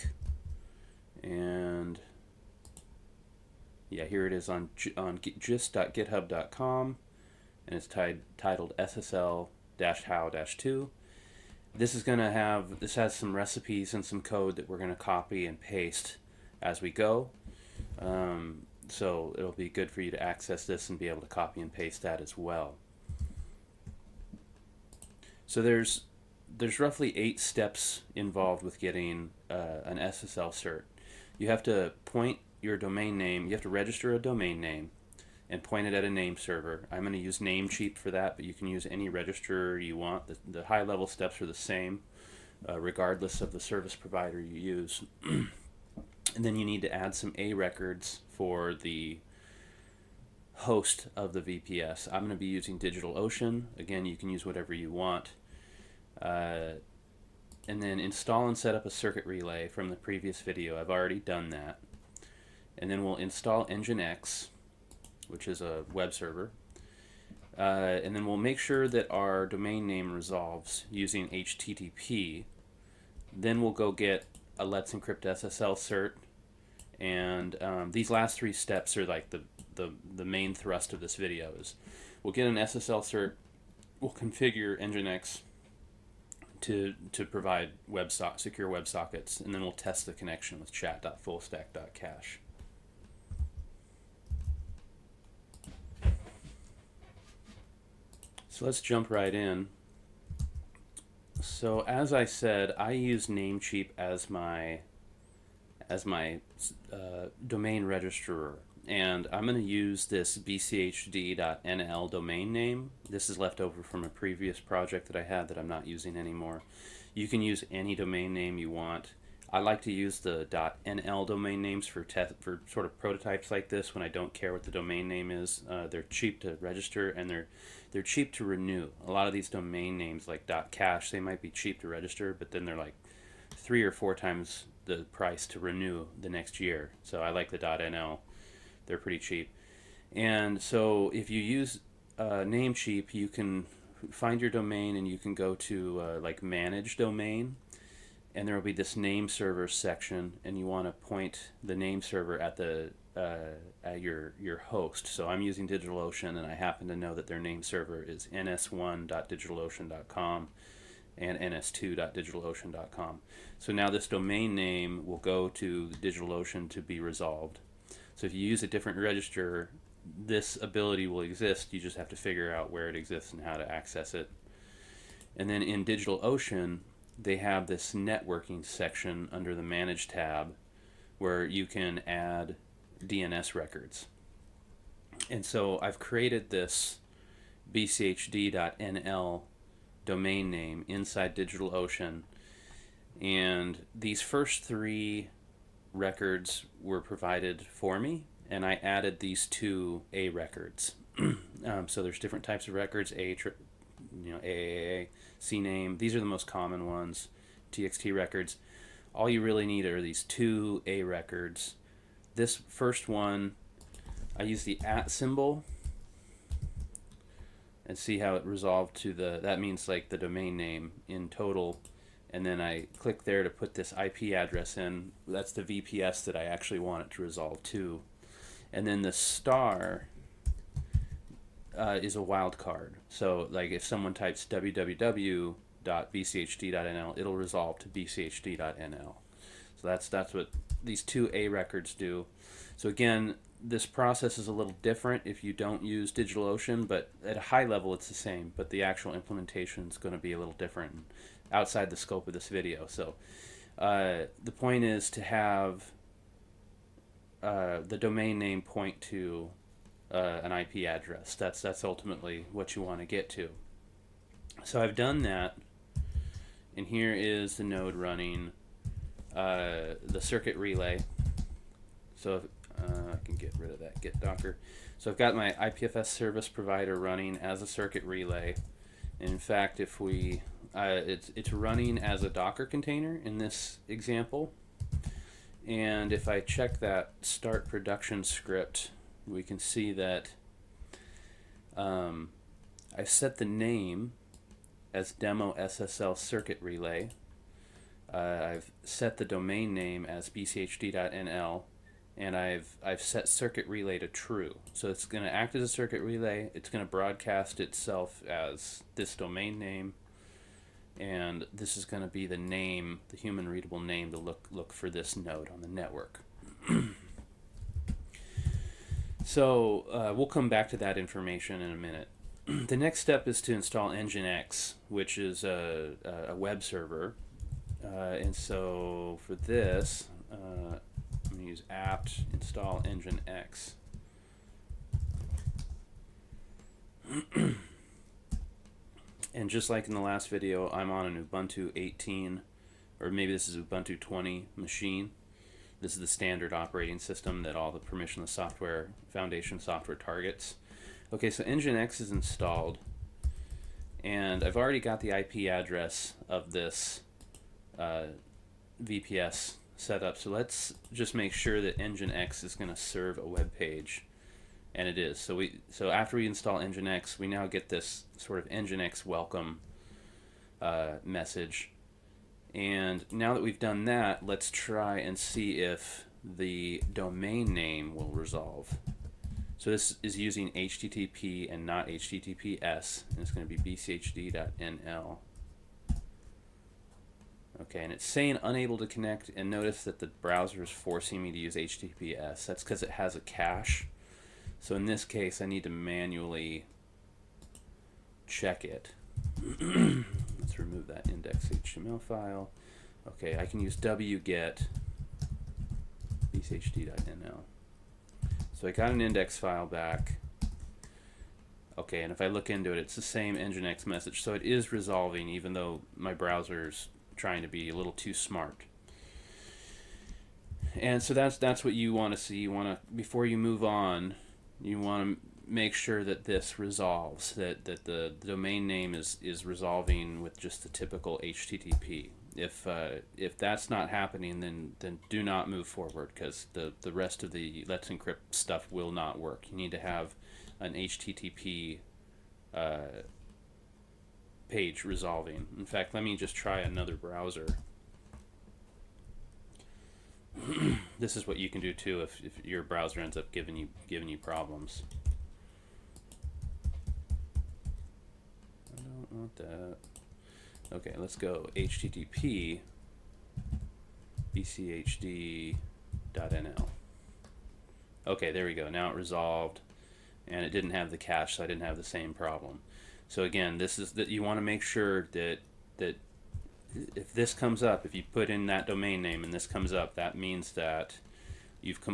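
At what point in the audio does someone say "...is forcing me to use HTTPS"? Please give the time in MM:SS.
06:30.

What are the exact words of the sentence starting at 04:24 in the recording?
So I've done that, and here is the node running uh, the circuit relay.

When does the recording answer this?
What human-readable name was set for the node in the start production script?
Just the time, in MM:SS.
04:55.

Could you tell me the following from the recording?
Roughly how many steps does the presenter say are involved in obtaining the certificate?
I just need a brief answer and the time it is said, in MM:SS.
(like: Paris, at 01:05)
8, at 00:27.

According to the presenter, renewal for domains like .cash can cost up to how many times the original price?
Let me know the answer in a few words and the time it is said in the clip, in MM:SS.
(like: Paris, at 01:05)
3 or 4 times, at 02:13.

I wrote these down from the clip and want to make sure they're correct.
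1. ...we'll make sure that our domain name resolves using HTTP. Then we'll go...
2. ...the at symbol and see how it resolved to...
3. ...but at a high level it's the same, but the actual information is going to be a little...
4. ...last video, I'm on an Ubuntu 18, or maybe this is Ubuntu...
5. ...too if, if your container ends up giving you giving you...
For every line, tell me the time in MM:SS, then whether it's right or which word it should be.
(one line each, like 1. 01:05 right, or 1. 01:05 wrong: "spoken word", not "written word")
1. 01:08 right
2. 03:34 right
3. 04:06 wrong: "implementation", not "information"
4. 05:40 right
5. 07:31 wrong: "browser", not "container".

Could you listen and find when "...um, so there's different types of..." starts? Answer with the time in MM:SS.
03:21.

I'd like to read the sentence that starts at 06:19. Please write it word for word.
So this is using HTTP and not HTTPS, and it's going to be bchd.nl.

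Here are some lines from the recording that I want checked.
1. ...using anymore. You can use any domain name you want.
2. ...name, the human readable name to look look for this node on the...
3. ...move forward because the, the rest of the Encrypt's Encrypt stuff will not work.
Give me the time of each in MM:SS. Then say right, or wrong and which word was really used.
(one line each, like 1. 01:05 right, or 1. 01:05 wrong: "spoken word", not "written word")
1. 01:55 right
2. 05:12 right
3. 07:15 wrong: "Let", not "Encrypt".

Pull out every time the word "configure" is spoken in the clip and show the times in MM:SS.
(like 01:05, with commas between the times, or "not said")
01:24.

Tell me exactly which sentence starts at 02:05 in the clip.
Uh, they're cheap to register and they're they're cheap to renew.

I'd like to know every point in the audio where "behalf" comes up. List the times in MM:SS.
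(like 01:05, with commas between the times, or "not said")
not said.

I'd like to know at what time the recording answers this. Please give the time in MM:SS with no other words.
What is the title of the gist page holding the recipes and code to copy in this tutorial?
00:08.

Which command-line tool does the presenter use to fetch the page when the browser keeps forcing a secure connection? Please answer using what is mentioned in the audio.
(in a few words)
wget.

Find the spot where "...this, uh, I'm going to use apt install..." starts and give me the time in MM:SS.
05:29.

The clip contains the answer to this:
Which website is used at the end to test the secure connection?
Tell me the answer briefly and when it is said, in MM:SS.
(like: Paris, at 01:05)
chat.fullstack.cash, at 01:30.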